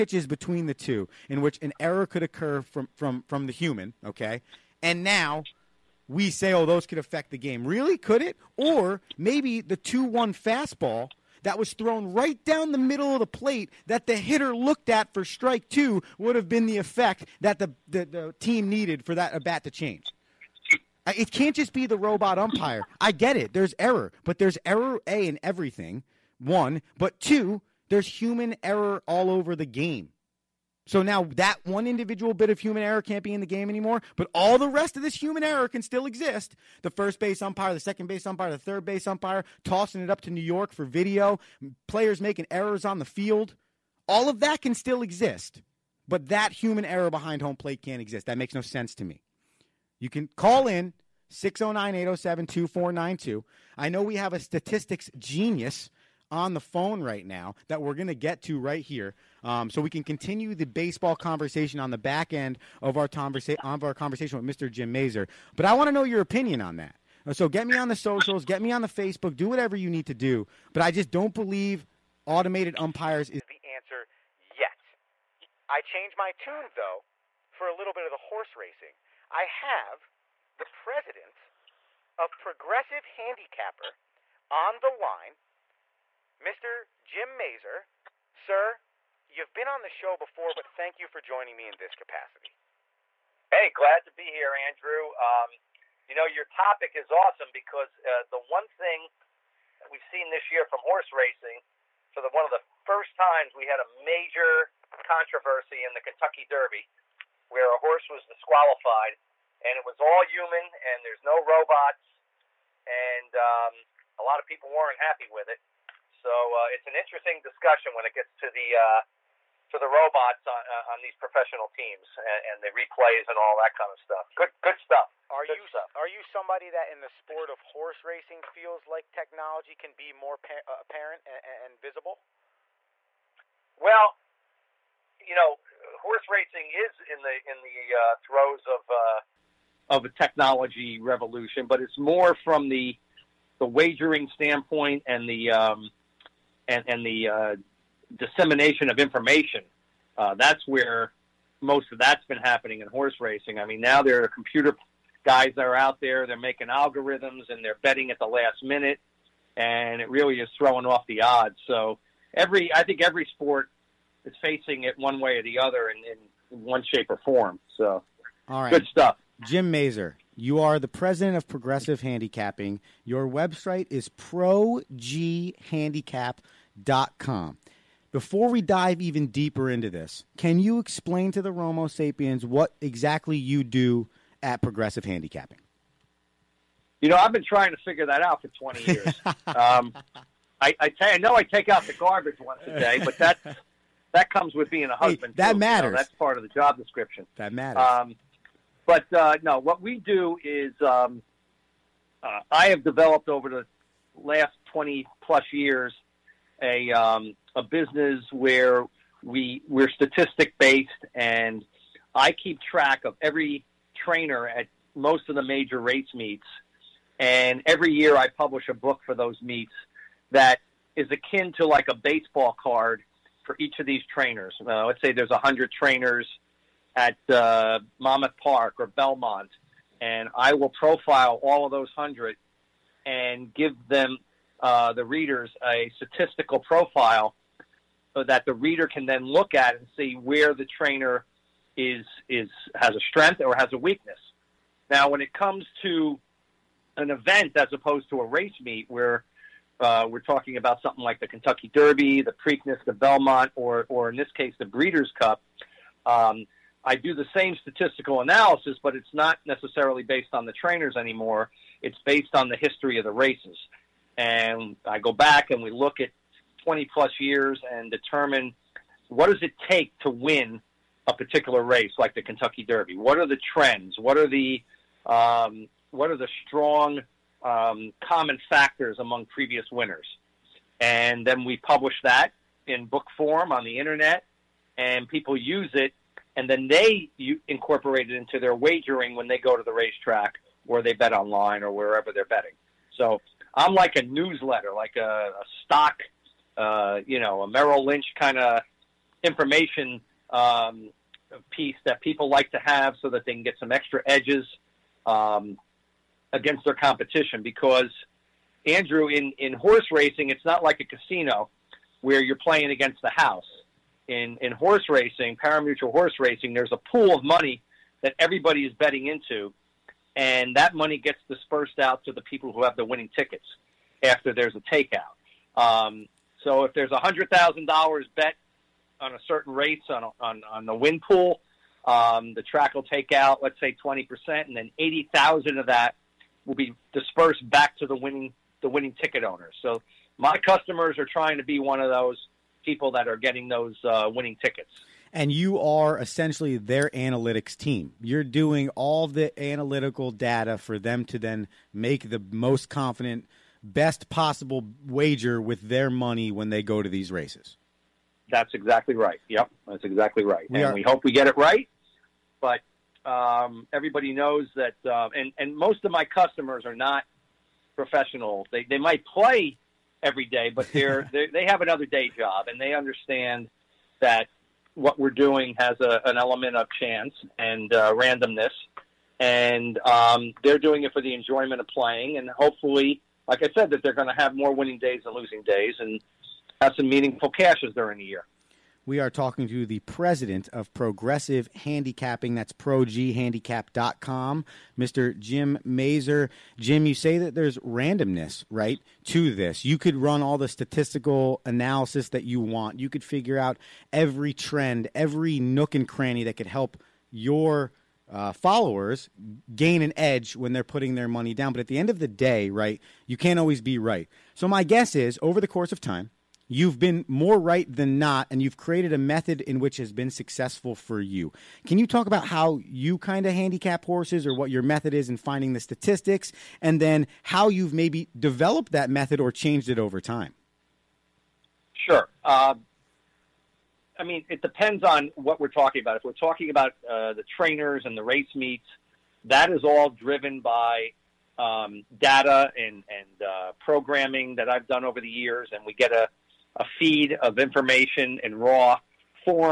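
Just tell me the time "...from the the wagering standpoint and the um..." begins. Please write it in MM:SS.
02:22.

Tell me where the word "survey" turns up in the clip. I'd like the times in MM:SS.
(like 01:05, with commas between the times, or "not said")
not said.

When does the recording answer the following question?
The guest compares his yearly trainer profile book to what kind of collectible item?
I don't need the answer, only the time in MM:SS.
03:41.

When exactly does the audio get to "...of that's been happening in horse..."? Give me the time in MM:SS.
02:31.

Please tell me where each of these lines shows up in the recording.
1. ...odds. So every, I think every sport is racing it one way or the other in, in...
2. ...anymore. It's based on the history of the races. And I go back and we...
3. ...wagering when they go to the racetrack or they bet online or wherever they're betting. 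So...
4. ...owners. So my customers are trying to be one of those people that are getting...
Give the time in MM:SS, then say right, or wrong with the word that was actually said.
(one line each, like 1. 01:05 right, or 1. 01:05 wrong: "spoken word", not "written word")
1. 02:41 wrong: "facing", not "racing"
2. 04:20 right
3. 04:48 right
4. 05:39 right.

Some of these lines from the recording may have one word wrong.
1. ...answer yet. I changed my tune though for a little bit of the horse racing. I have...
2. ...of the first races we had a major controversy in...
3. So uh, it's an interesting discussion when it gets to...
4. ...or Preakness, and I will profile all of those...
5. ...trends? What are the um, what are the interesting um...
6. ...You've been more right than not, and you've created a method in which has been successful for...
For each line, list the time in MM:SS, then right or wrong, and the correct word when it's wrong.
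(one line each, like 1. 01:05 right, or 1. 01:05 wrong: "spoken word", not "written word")
1. 01:13 right
2. 01:42 wrong: "times", not "races"
3. 01:56 right
4. 03:48 wrong: "Belmont", not "Preakness"
5. 04:33 wrong: "strong", not "interesting"
6. 06:56 right.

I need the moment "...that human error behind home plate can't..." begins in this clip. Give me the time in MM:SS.
00:46.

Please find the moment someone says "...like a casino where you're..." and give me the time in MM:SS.
05:10.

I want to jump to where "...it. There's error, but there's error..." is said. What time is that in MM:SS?
00:23.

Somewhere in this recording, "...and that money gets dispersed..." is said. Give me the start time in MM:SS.
05:20.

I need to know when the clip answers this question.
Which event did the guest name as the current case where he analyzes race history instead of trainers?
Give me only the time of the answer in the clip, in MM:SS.
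04:14.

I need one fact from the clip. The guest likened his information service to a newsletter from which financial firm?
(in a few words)
Merrill Lynch.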